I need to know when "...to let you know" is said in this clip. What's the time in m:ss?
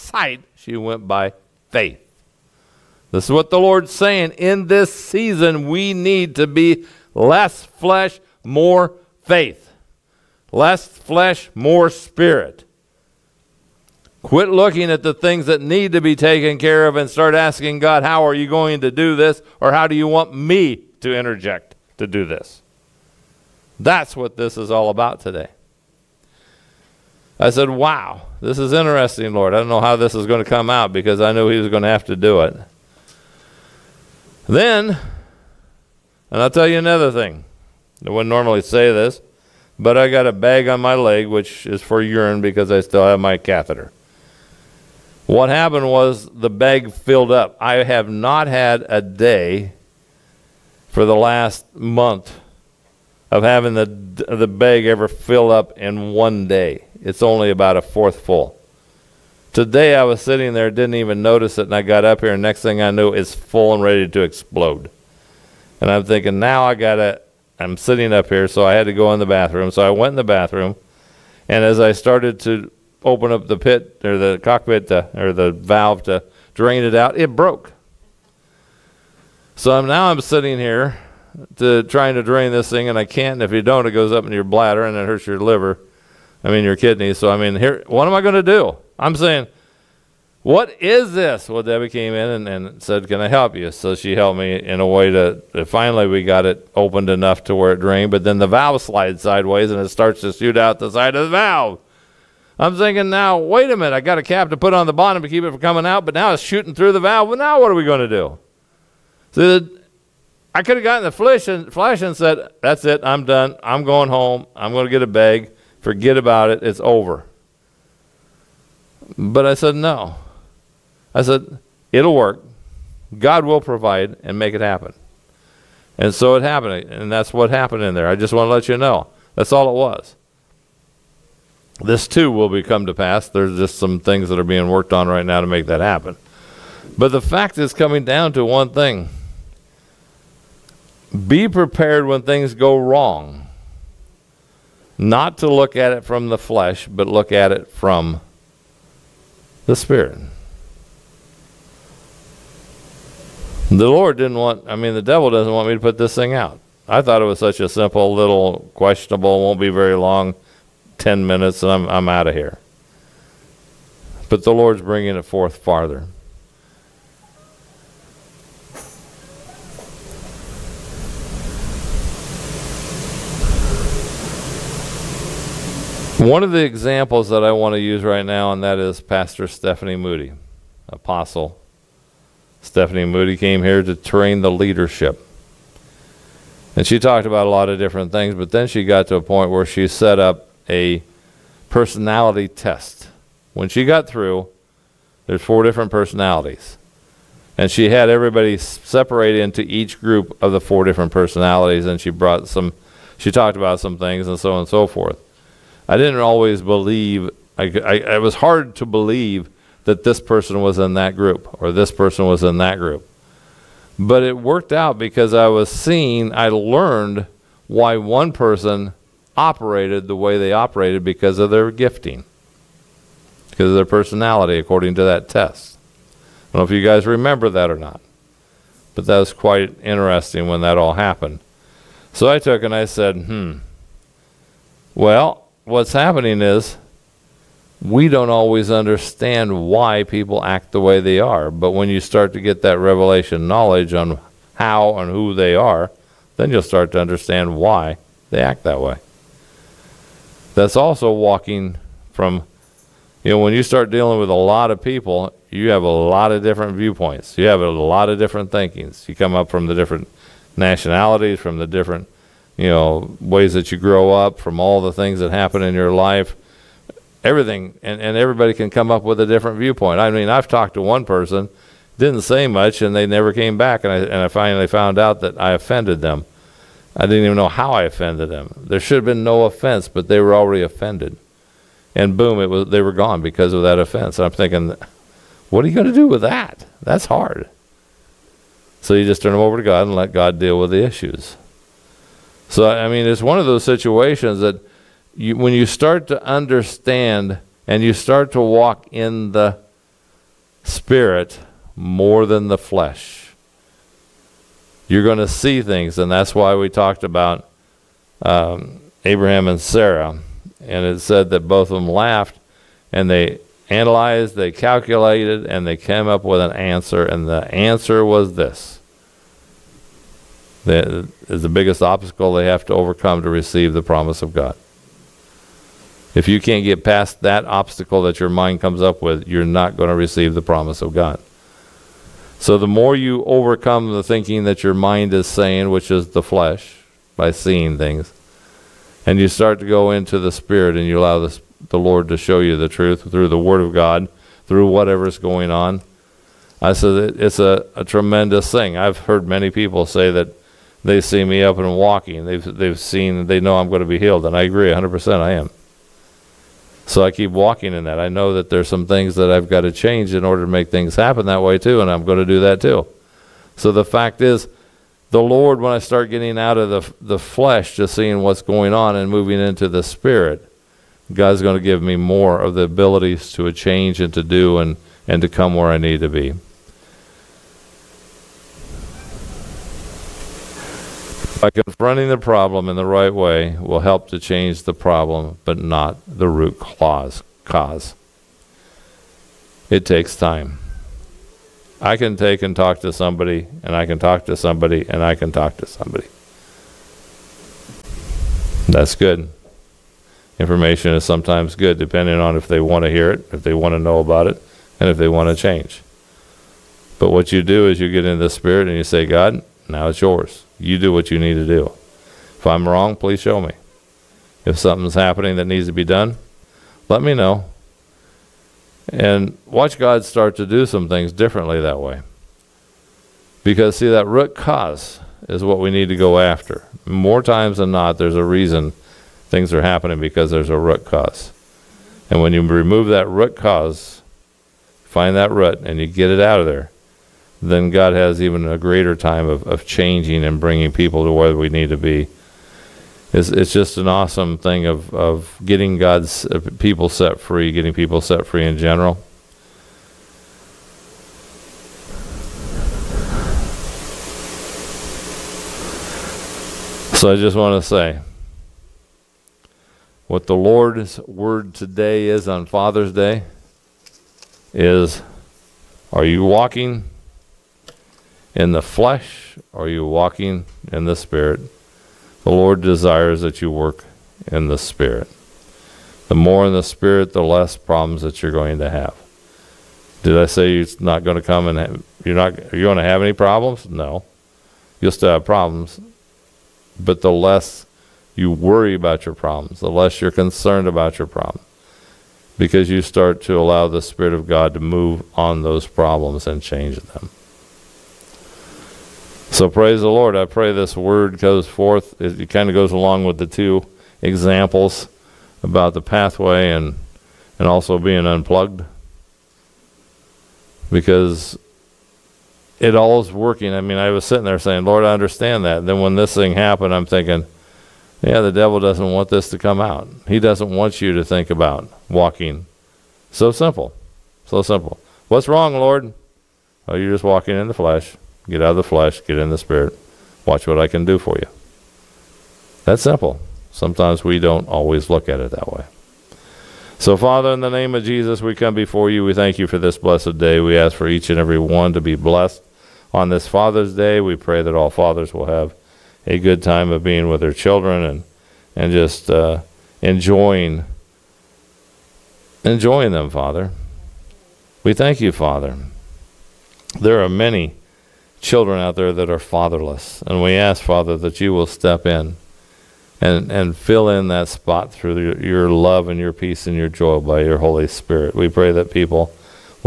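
2:08.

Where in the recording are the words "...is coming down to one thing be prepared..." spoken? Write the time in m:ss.
2:17.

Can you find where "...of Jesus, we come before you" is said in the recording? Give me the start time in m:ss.
8:57.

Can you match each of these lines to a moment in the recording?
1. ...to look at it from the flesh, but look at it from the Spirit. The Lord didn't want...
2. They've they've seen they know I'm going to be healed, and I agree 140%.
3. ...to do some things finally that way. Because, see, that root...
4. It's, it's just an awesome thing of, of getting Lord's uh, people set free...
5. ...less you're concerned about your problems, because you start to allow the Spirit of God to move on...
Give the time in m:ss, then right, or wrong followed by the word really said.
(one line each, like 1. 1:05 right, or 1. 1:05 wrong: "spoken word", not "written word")
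1. 2:25 right
2. 5:52 wrong: "100", not "140"
3. 7:00 wrong: "differently", not "finally"
4. 7:23 wrong: "God", not "Lord"
5. 8:09 right.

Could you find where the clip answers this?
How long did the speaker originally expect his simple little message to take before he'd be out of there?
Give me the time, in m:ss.
2:40.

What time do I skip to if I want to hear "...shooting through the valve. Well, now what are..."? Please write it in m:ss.
1:46.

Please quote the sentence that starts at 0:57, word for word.
It's only about a fourth full.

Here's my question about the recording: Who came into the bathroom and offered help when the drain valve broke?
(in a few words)
Debbie.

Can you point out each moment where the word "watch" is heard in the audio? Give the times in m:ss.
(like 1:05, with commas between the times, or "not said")
6:59, 8:50.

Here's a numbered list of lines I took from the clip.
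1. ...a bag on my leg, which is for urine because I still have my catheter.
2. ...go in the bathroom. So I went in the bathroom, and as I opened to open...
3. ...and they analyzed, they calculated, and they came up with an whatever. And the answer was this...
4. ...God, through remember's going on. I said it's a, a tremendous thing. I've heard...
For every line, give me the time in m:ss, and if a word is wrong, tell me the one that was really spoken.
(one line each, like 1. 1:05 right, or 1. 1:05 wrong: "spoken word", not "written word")
1. 0:40 right
2. 1:08 wrong: "started", not "opened"
3. 5:12 wrong: "answer", not "whatever"
4. 5:43 wrong: "whatever", not "remember".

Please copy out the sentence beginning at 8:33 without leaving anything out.
I mean, I was sitting there saying, Lord, I understand that.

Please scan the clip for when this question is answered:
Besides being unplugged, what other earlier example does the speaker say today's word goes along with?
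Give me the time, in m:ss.
8:25.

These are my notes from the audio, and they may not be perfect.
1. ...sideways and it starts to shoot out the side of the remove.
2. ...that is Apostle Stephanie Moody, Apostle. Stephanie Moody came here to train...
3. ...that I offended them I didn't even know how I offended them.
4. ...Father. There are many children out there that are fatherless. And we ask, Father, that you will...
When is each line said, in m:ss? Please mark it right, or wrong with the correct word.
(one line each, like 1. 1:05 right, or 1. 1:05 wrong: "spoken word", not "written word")
1. 1:39 wrong: "valve", not "remove"
2. 2:58 wrong: "Pastor", not "Apostle"
3. 4:35 right
4. 9:15 right.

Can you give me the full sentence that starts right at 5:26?
If you can't get past that obstacle that your mind comes up with, you're not going to receive the promise of God.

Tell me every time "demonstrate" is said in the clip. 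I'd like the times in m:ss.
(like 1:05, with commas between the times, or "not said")
not said.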